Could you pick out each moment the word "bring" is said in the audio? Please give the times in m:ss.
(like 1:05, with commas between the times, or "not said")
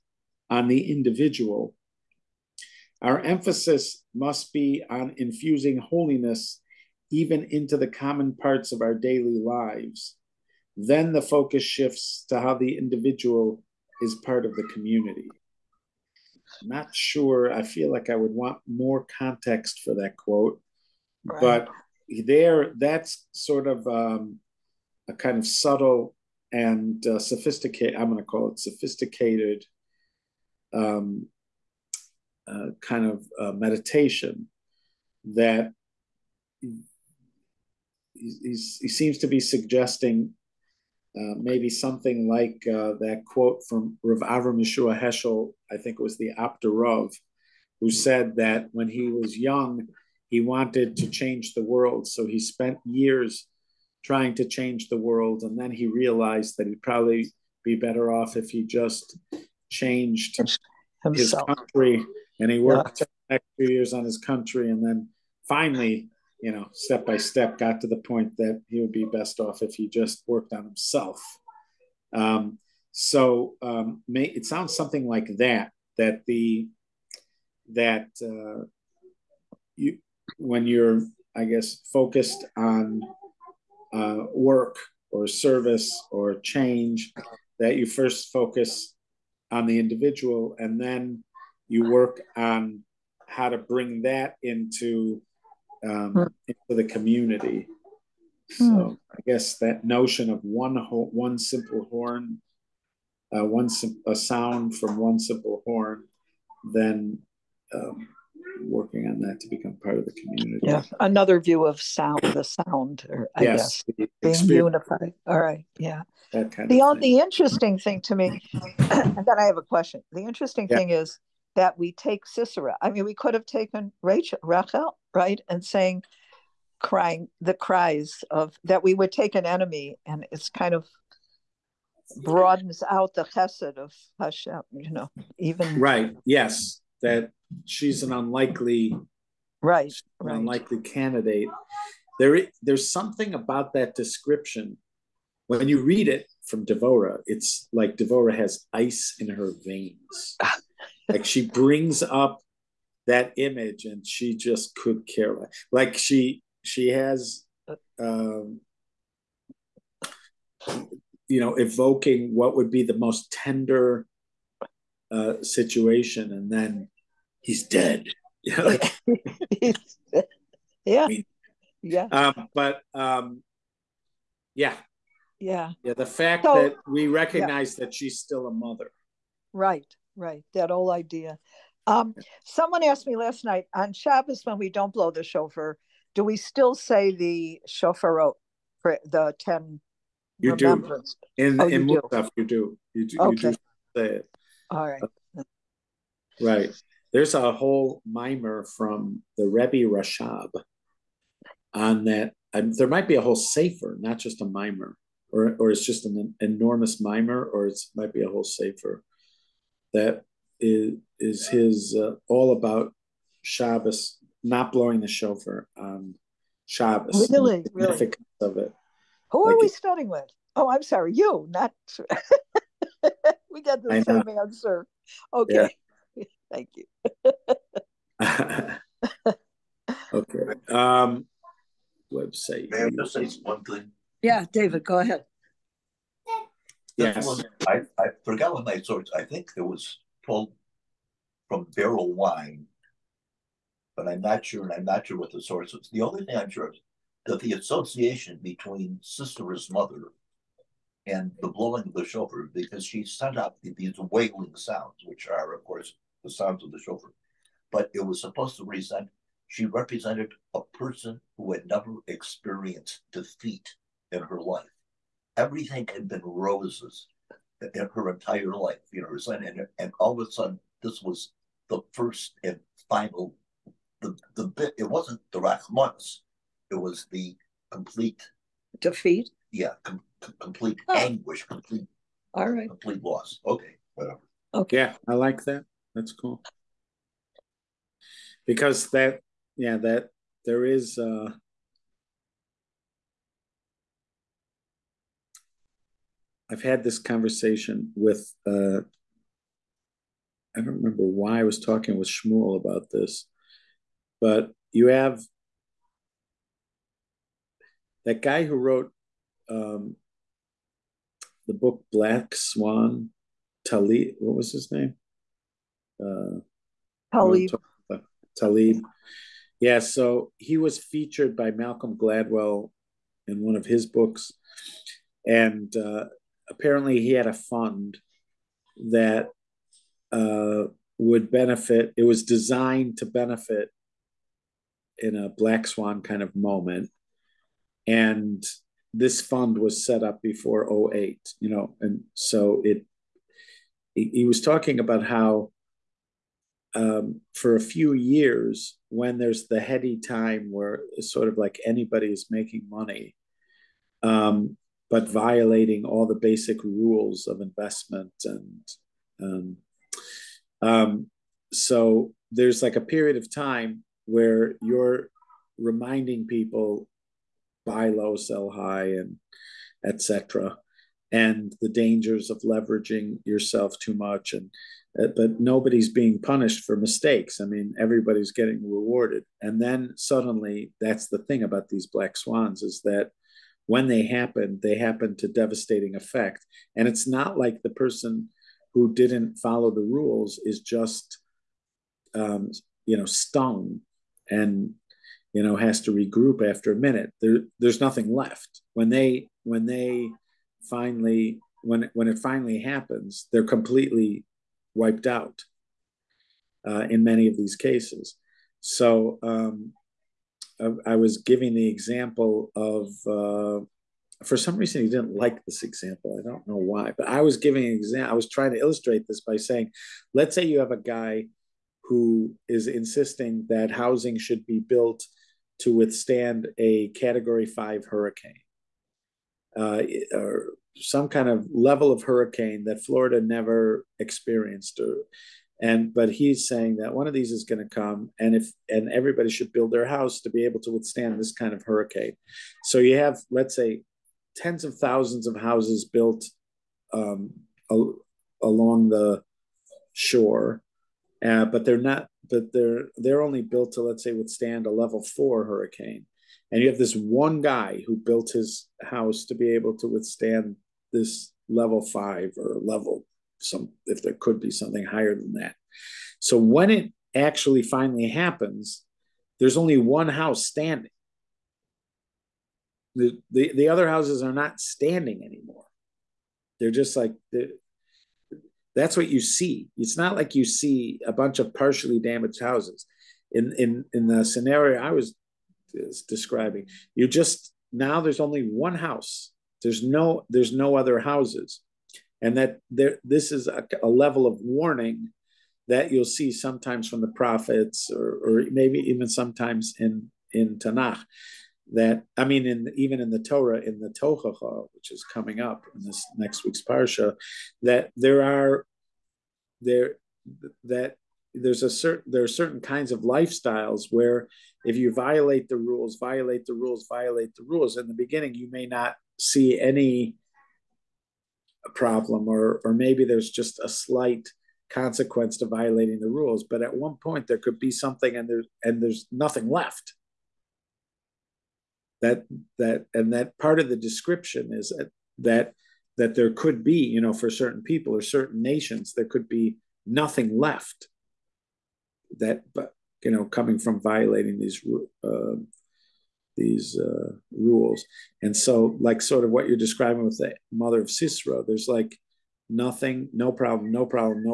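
1:33, 2:31.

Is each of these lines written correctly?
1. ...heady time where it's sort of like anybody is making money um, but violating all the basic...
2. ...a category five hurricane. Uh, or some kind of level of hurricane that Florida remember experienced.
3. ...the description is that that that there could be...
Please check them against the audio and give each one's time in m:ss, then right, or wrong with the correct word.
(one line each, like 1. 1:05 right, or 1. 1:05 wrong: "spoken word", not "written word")
1. 5:49 right
2. 7:06 wrong: "never", not "remember"
3. 8:53 right.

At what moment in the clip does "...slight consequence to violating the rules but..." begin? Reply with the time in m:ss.
8:43.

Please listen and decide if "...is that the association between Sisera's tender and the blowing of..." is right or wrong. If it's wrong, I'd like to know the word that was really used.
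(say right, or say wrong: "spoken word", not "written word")
wrong: "mother", not "tender".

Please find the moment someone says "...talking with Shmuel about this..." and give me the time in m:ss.
5:01.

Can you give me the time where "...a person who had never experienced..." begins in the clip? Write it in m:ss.
4:20.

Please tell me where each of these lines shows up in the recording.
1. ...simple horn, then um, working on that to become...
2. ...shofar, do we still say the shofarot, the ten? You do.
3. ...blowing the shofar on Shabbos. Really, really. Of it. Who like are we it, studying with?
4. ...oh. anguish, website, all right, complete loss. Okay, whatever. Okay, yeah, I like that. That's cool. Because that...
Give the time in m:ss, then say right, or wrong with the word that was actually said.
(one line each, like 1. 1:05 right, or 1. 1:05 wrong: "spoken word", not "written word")
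1. 1:45 right
2. 3:05 right
3. 3:34 right
4. 4:40 wrong: "complete", not "website".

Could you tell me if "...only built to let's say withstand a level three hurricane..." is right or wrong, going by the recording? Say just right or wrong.
wrong.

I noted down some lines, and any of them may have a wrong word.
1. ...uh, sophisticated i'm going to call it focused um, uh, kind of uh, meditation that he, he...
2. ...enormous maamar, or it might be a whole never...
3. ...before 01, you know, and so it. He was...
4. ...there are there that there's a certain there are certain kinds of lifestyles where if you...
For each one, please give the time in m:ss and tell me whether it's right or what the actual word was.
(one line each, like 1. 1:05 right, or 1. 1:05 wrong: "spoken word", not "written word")
1. 0:27 wrong: "sophisticated", not "focused"
2. 3:26 wrong: "sefer", not "never"
3. 5:40 wrong: "08", not "01"
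4. 8:27 right.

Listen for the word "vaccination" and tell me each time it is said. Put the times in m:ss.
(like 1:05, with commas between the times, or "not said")
not said.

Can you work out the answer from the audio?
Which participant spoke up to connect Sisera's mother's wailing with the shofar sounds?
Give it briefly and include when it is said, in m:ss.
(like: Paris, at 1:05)
David, at 3:54.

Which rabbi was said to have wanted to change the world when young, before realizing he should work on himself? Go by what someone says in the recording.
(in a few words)
The Apter Rov.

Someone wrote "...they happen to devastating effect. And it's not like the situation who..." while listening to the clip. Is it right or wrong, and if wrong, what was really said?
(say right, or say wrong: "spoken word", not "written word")
wrong: "person", not "situation".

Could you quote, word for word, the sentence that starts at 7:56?
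They're just like, they're, that's what you see.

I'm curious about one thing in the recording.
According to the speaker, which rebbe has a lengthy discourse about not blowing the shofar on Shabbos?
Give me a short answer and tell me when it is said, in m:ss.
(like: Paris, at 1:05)
Rebbe Rashab, at 3:19.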